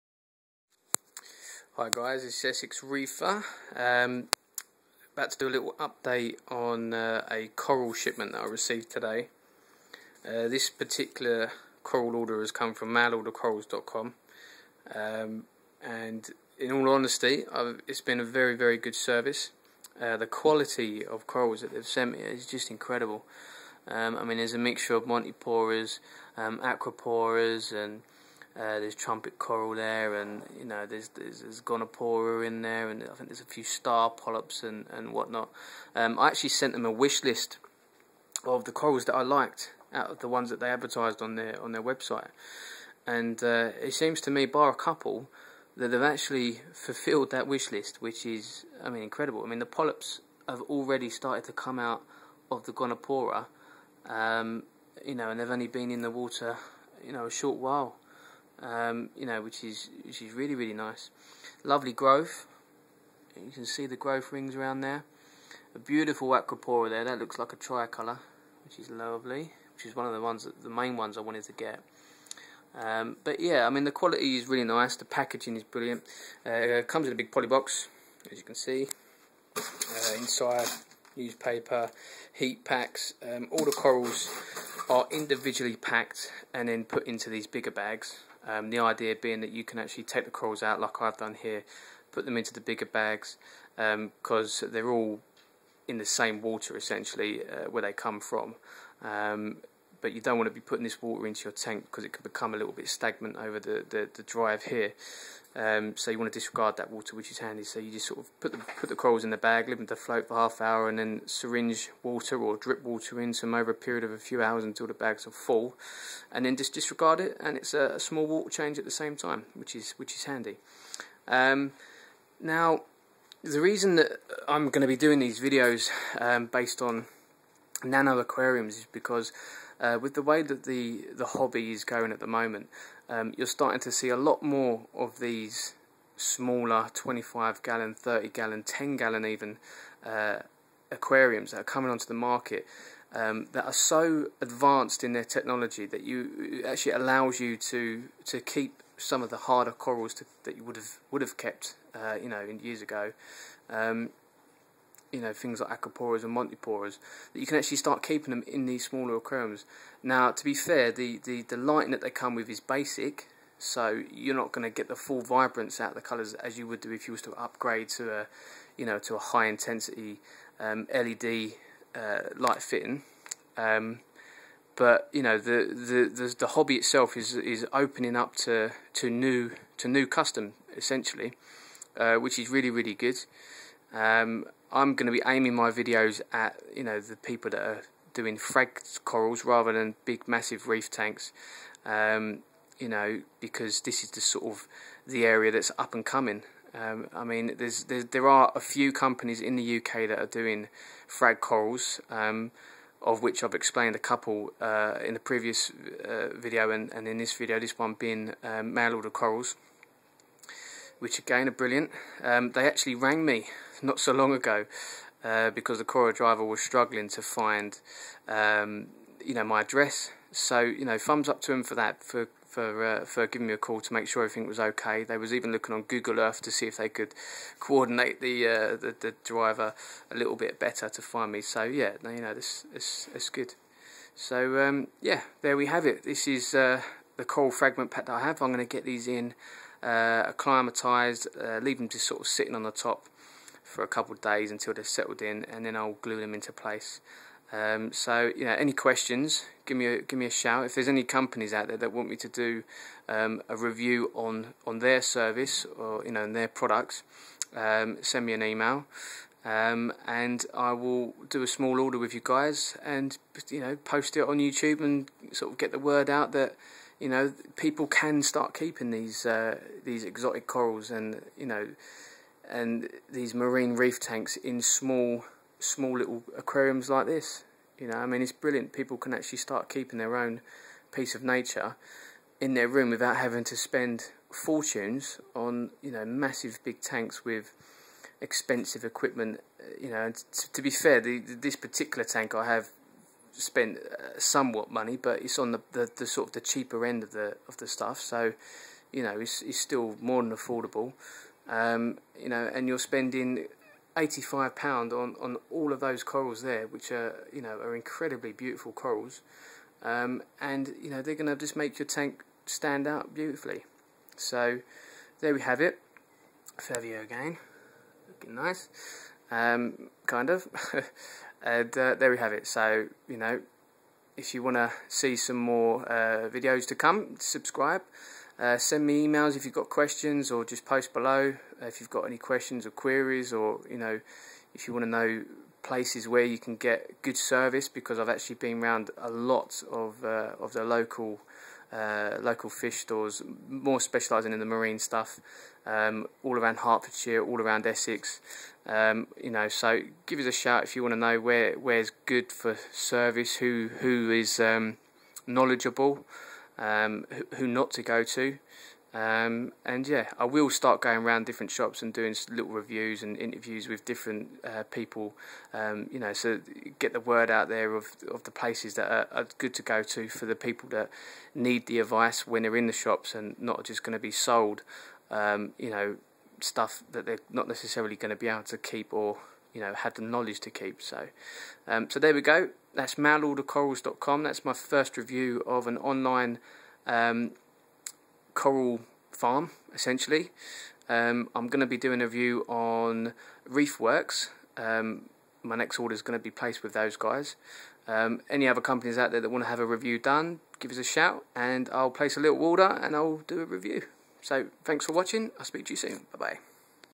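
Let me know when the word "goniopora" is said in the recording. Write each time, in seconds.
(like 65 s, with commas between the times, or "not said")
31 s, 52 s.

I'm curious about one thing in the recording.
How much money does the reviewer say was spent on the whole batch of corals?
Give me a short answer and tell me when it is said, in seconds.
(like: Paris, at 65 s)
85 pounds, at 303 s.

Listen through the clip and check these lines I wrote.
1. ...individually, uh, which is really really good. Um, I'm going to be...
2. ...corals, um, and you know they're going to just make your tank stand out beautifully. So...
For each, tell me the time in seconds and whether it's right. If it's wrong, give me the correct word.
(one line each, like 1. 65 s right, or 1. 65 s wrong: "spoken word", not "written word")
1. 180 s wrong: "essentially", not "individually"
2. 308 s right.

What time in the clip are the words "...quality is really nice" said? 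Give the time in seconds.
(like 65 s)
73 s.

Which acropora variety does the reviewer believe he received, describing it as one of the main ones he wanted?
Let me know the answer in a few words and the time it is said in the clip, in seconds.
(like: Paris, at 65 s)
tricolour, at 67 s.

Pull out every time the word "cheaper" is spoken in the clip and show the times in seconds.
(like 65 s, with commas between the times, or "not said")
296 s.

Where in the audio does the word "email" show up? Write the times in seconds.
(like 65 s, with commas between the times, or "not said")
258 s, 329 s.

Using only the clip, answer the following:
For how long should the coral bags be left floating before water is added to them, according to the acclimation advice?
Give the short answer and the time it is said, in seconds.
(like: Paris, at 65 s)
half an hour, at 110 s.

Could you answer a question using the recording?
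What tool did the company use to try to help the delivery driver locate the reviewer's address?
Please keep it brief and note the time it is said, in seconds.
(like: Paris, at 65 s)
Google Earth, at 225 s.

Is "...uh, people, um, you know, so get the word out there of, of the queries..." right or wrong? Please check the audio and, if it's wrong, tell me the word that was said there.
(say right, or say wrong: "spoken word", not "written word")
wrong: "places", not "queries".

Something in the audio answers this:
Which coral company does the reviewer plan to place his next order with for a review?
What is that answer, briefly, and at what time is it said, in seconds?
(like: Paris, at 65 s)
Reef Works, at 393 s.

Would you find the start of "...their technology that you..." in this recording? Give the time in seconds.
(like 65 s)
145 s.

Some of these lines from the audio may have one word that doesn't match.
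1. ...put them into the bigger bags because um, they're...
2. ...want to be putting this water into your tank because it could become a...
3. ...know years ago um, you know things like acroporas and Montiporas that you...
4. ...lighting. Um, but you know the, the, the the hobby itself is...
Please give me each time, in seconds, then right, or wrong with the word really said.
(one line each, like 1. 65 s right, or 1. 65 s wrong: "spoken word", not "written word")
1. 92 s right
2. 100 s right
3. 152 s right
4. 172 s wrong: "fitting", not "lighting".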